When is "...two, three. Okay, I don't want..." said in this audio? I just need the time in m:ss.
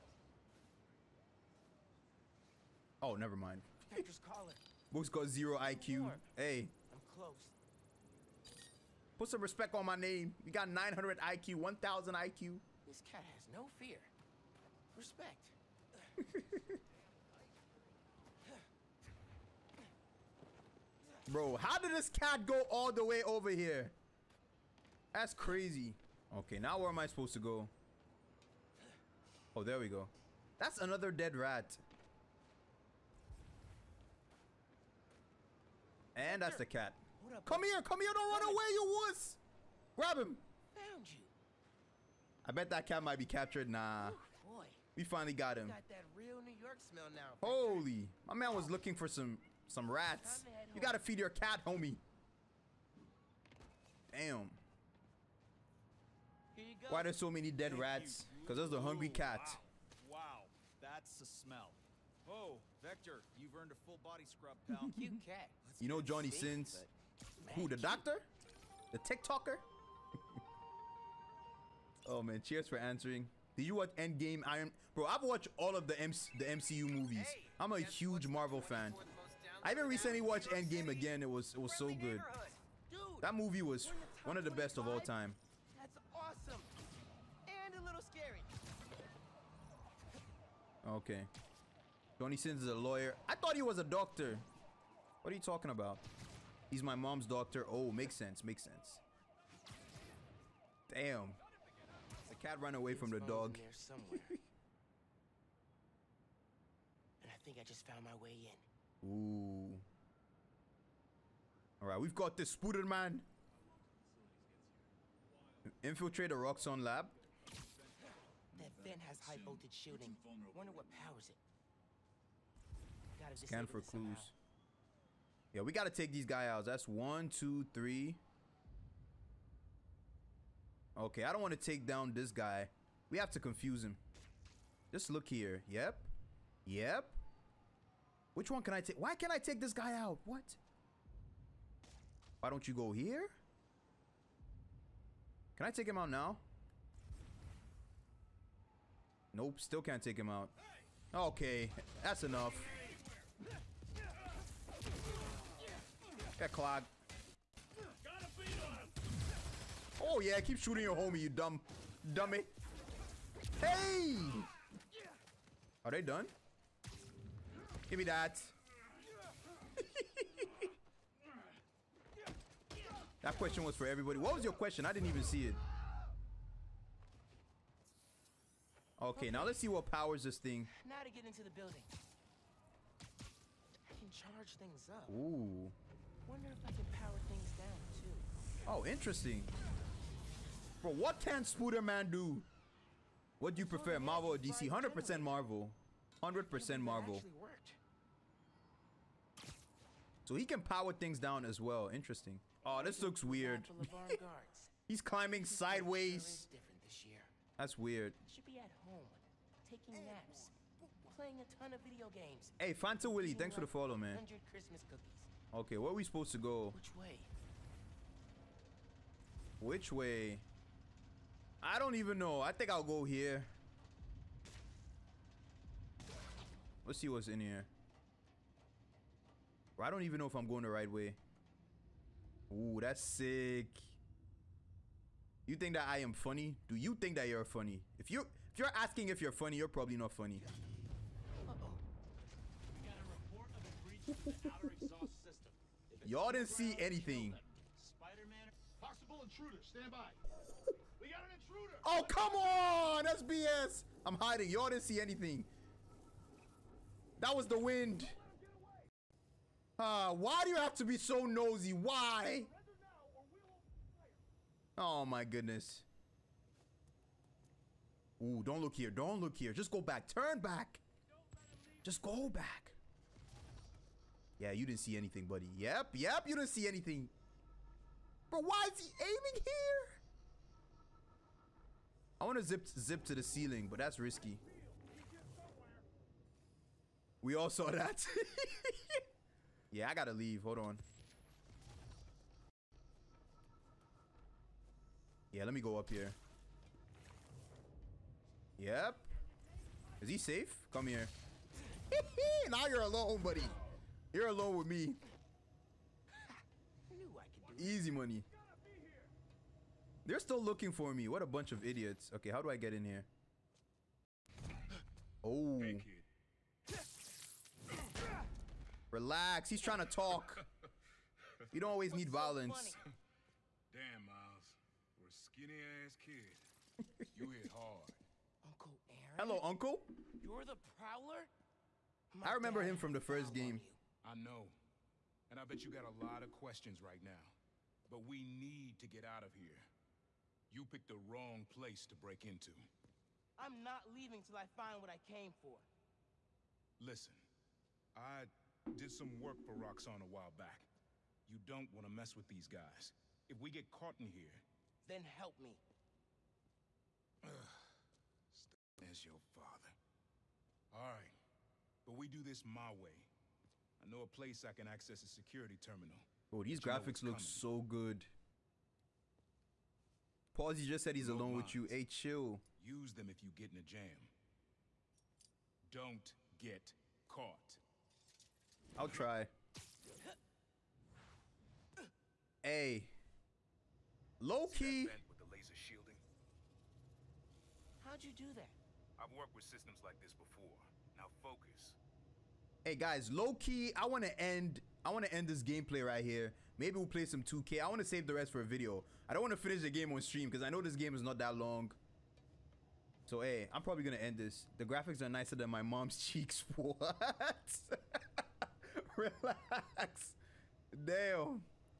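2:07.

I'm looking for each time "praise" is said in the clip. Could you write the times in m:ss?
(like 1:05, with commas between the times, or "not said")
not said.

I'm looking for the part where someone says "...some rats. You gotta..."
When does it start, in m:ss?
0:49.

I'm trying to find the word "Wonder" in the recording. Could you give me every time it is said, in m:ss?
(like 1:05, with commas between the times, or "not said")
2:00, 3:06.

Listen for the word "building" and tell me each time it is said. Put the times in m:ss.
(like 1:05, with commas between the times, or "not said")
3:01.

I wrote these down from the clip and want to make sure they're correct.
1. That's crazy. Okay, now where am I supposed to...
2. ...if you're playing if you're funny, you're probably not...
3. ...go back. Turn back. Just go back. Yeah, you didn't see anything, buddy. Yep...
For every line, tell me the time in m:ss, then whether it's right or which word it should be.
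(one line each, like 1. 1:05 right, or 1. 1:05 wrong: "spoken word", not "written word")
1. 0:25 right
2. 3:58 wrong: "asking", not "playing"
3. 4:29 right.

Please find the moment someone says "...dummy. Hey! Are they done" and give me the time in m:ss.
2:42.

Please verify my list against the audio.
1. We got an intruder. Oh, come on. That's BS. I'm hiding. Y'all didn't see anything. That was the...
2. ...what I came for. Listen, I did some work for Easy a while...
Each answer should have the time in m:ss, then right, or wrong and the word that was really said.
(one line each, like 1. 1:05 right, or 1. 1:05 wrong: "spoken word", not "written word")
1. 4:11 right
2. 5:44 wrong: "Roxxon", not "Easy".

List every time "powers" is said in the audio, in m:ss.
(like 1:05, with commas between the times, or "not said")
2:00, 2:59, 3:06, 3:20.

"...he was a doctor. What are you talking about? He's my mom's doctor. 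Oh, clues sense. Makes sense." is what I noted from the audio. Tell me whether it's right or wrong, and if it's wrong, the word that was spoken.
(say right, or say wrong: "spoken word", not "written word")
wrong: "makes", not "clues".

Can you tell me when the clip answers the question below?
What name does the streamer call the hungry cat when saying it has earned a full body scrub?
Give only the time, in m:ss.
1:02.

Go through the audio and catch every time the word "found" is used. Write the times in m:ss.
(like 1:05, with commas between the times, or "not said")
0:40, 1:47.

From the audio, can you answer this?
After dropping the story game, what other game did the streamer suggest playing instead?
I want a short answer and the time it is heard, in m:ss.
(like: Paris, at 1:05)
2K, at 6:37.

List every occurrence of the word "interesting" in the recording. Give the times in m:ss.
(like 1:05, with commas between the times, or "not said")
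3:08, 3:21.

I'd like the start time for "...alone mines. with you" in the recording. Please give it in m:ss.
6:11.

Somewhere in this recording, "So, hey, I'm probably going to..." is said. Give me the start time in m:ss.
6:43.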